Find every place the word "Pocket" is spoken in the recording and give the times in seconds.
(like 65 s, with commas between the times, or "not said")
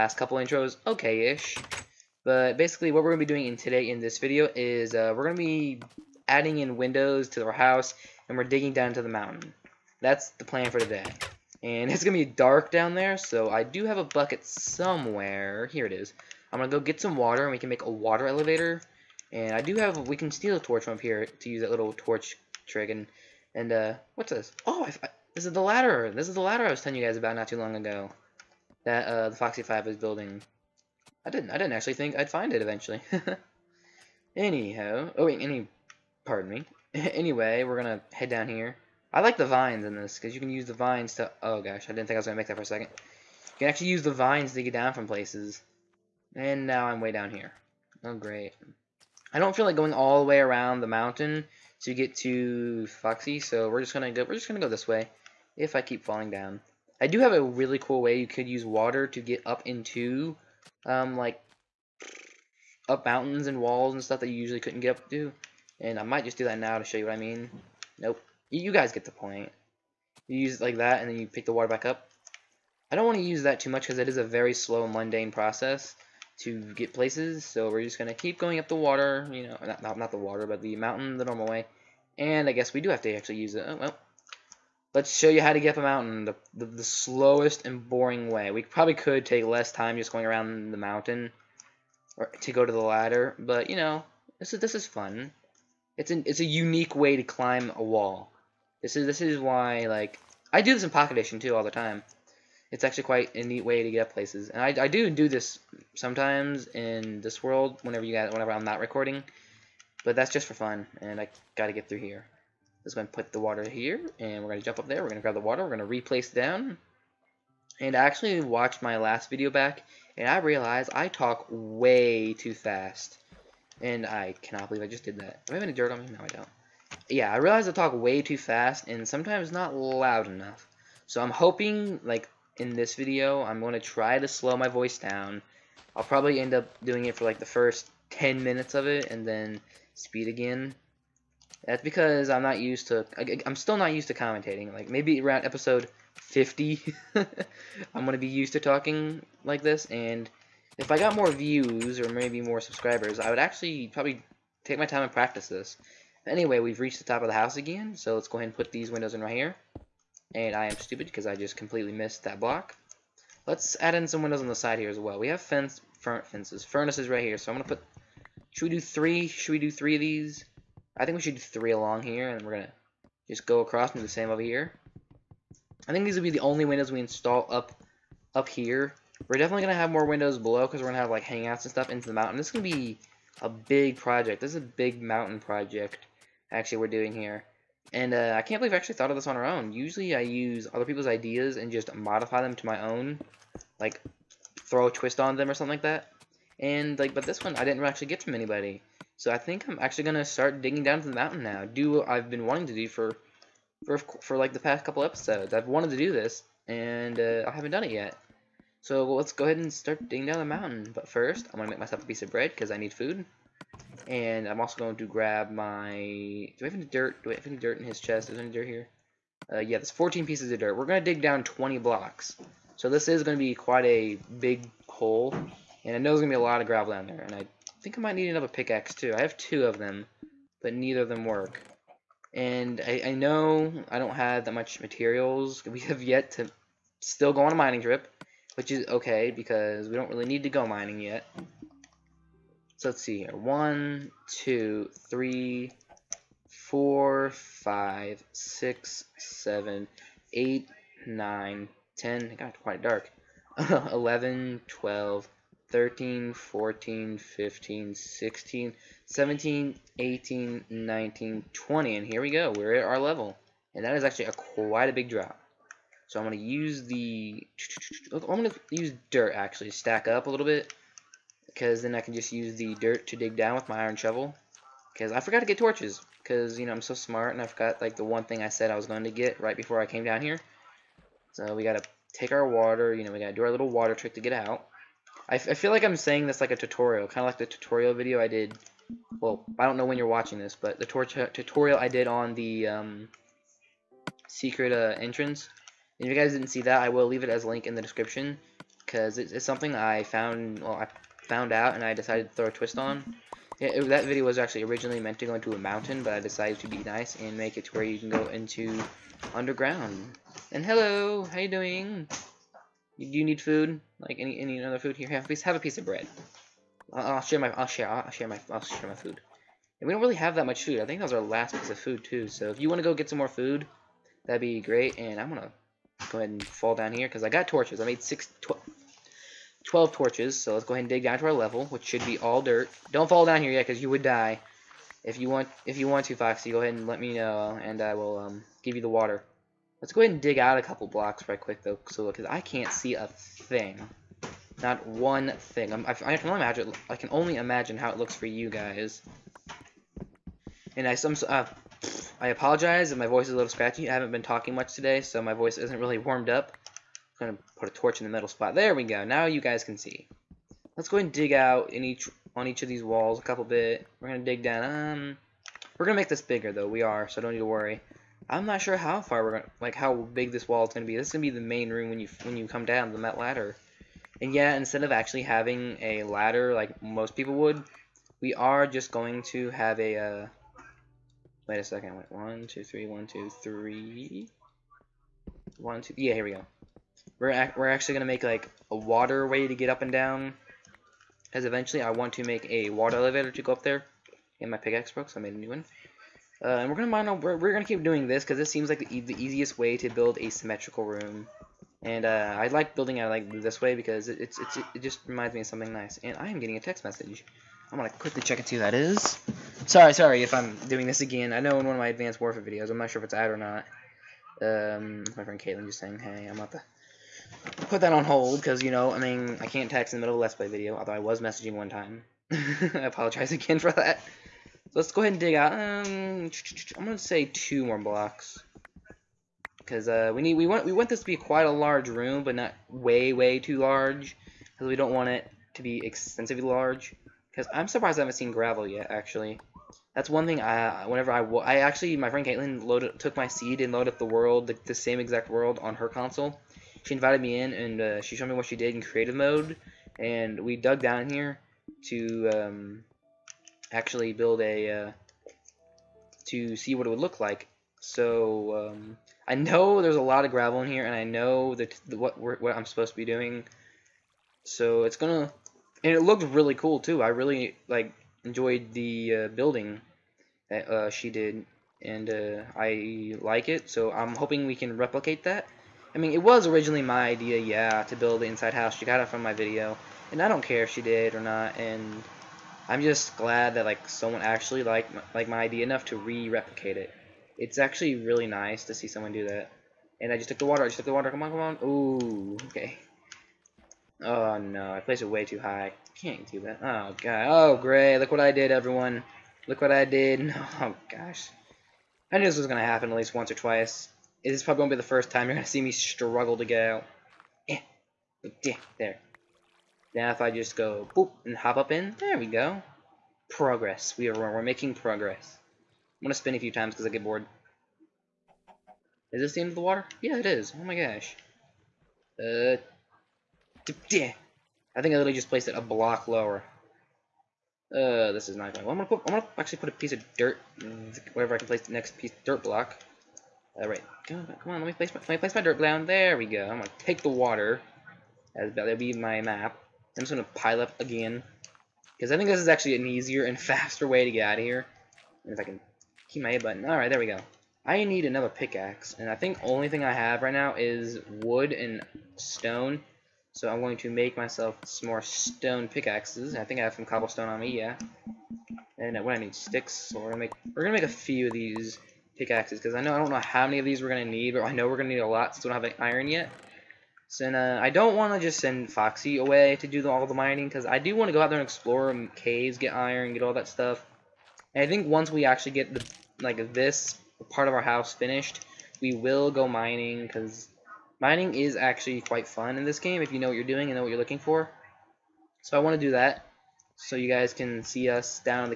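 100 s.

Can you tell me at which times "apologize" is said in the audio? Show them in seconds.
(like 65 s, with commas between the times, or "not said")
352 s, 422 s.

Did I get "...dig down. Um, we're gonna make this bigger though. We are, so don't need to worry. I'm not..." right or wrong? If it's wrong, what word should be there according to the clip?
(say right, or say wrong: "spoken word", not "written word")
right.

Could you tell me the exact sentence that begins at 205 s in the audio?
I've wanted to do this, and uh, I haven't done it yet.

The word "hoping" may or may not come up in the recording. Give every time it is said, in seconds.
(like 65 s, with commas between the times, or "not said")
131 s, 474 s.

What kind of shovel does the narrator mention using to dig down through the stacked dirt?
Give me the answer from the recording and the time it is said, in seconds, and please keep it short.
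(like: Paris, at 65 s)
iron shovel, at 273 s.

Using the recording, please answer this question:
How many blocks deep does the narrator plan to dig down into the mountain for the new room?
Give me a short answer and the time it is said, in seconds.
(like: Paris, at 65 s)
20, at 221 s.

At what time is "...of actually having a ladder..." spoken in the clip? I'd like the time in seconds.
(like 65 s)
374 s.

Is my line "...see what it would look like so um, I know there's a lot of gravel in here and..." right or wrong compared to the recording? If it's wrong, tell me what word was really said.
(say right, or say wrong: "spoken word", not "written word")
right.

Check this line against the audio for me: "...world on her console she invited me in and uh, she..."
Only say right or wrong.
right.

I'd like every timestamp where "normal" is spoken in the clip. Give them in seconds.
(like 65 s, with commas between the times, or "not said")
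81 s.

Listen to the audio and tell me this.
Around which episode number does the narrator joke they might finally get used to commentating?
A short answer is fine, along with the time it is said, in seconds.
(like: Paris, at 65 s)
50, at 145 s.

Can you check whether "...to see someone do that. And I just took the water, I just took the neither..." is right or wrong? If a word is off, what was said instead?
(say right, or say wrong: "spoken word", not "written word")
wrong: "water", not "neither".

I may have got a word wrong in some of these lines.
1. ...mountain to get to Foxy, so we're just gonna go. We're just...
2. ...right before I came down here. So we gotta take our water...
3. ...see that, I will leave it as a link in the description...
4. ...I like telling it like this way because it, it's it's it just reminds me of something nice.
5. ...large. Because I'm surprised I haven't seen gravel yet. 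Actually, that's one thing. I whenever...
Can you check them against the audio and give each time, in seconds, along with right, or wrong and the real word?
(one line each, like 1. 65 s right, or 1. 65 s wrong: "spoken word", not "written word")
1. 50 s right
2. 279 s right
3. 296 s right
4. 402 s wrong: "building", not "telling"
5. 436 s right.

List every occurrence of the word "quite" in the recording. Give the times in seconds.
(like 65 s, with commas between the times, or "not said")
103 s, 223 s, 252 s, 264 s, 431 s, 582 s.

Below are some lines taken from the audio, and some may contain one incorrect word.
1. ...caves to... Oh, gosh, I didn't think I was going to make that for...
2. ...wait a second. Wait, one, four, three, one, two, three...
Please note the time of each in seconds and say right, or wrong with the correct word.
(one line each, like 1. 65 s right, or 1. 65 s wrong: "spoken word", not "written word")
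1. 40 s wrong: "vines", not "caves"
2. 381 s wrong: "two", not "four".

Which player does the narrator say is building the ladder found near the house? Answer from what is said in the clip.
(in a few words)
Foxy 5.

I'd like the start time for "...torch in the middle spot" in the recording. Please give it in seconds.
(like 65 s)
357 s.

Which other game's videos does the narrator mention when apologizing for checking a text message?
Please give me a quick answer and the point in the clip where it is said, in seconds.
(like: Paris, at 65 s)
Advanced Warfare, at 411 s.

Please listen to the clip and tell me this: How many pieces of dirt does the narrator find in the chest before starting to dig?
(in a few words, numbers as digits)
14.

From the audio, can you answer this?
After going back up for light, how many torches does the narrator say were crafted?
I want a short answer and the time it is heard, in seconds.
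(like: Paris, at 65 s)
12, at 329 s.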